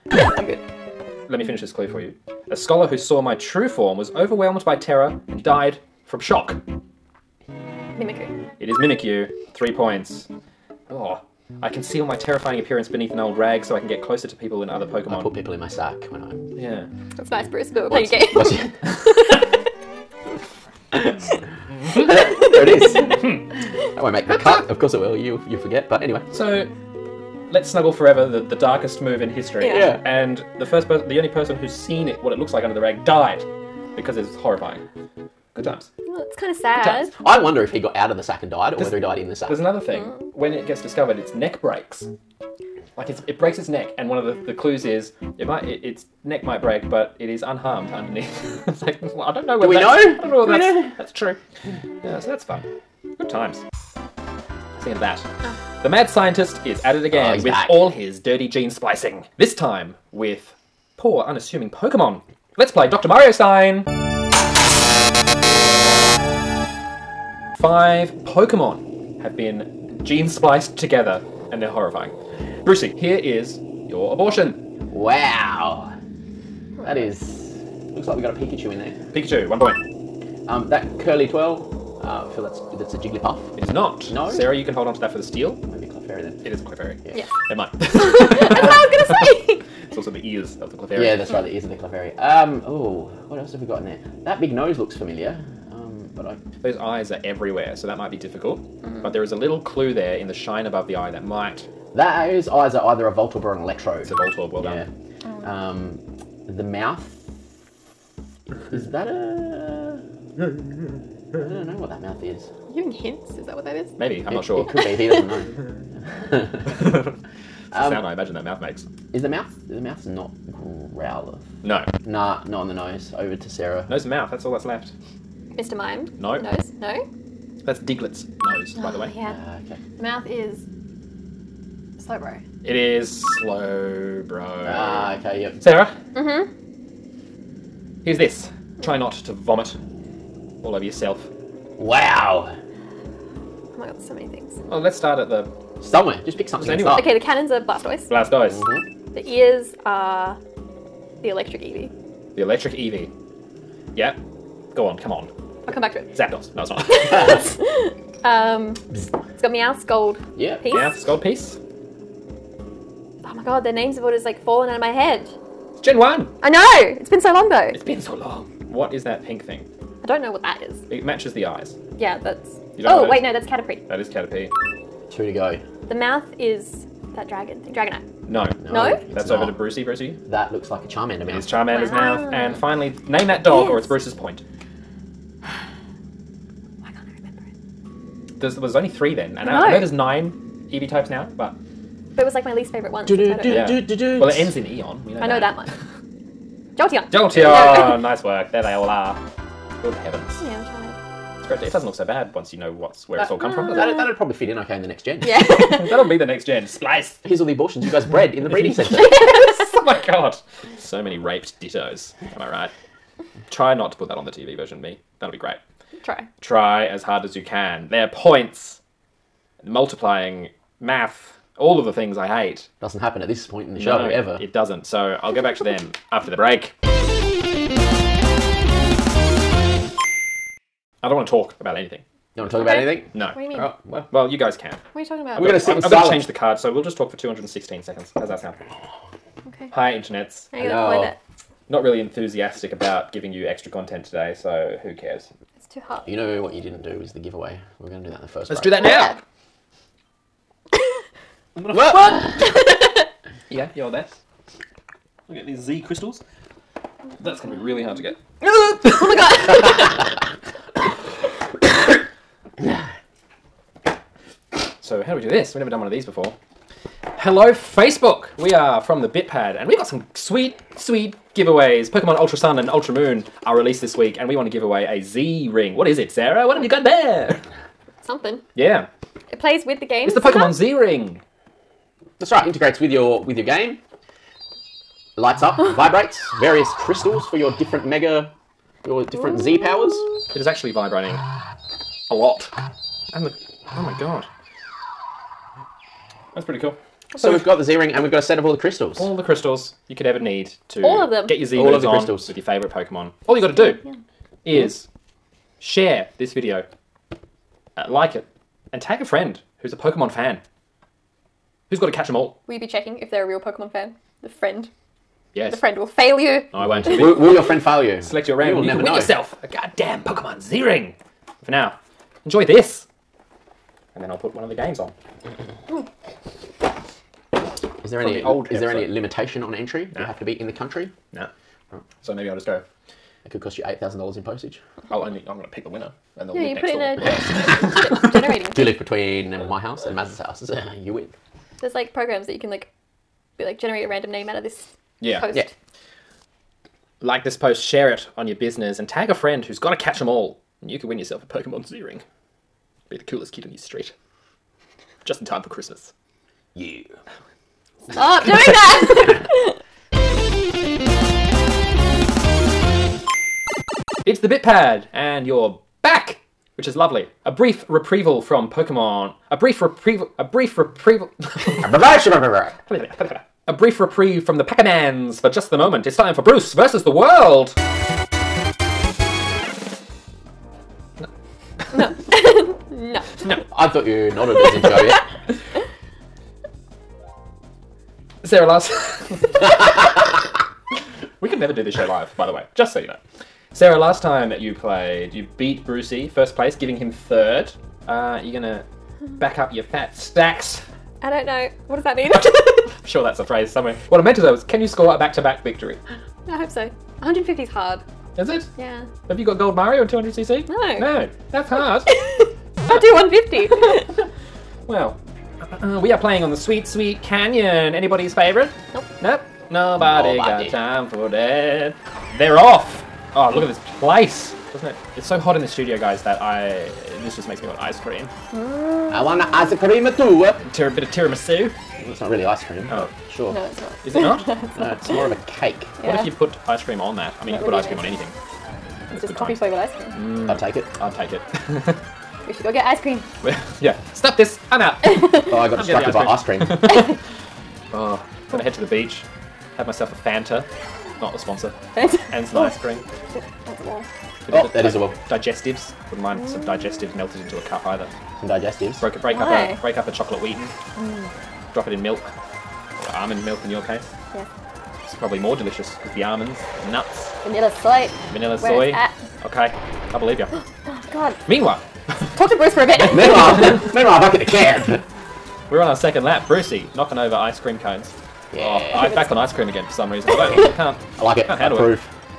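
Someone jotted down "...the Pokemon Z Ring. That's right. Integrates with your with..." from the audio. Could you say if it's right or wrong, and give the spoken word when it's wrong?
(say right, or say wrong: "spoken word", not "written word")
right.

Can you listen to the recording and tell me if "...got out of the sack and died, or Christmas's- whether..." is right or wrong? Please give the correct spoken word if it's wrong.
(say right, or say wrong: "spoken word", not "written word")
wrong: "There", not "Christmas".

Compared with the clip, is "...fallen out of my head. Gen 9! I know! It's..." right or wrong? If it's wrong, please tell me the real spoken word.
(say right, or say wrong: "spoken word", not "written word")
wrong: "1", not "9".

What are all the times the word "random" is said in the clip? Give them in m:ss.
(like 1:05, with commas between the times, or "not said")
5:18, 5:43.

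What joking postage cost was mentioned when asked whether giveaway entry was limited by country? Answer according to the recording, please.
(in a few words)
$8,000.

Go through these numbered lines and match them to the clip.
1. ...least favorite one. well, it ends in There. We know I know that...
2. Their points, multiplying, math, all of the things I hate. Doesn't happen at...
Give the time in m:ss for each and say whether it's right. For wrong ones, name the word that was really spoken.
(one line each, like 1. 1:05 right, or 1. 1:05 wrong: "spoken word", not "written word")
1. 3:12 wrong: "Eon", not "There"
2. 3:37 right.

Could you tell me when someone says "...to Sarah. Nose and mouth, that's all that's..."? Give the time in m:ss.
2:03.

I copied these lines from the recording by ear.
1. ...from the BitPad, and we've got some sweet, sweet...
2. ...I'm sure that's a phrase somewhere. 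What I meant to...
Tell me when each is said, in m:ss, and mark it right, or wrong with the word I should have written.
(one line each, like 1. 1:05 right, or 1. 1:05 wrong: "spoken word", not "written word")
1. 4:28 right
2. 6:42 right.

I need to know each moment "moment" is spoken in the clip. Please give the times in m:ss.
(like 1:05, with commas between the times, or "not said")
6:15.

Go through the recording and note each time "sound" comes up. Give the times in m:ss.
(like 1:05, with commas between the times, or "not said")
1:57, 3:58.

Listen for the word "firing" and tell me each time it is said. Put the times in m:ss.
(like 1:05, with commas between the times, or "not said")
not said.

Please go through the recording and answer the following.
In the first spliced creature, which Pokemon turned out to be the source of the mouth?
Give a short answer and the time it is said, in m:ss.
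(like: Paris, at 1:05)
Slowbro, at 2:12.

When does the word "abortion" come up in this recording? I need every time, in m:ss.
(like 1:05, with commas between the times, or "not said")
1:14, 3:27.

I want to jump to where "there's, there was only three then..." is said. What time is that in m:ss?
3:08.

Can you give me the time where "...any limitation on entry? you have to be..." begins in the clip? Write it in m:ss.
5:28.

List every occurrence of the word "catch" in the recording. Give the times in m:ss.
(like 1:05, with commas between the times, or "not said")
5:11, 5:49.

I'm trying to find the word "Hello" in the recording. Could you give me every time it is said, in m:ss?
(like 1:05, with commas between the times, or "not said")
4:00, 4:27.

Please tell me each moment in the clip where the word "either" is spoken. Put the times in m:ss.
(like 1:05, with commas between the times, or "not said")
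1:42, 7:37.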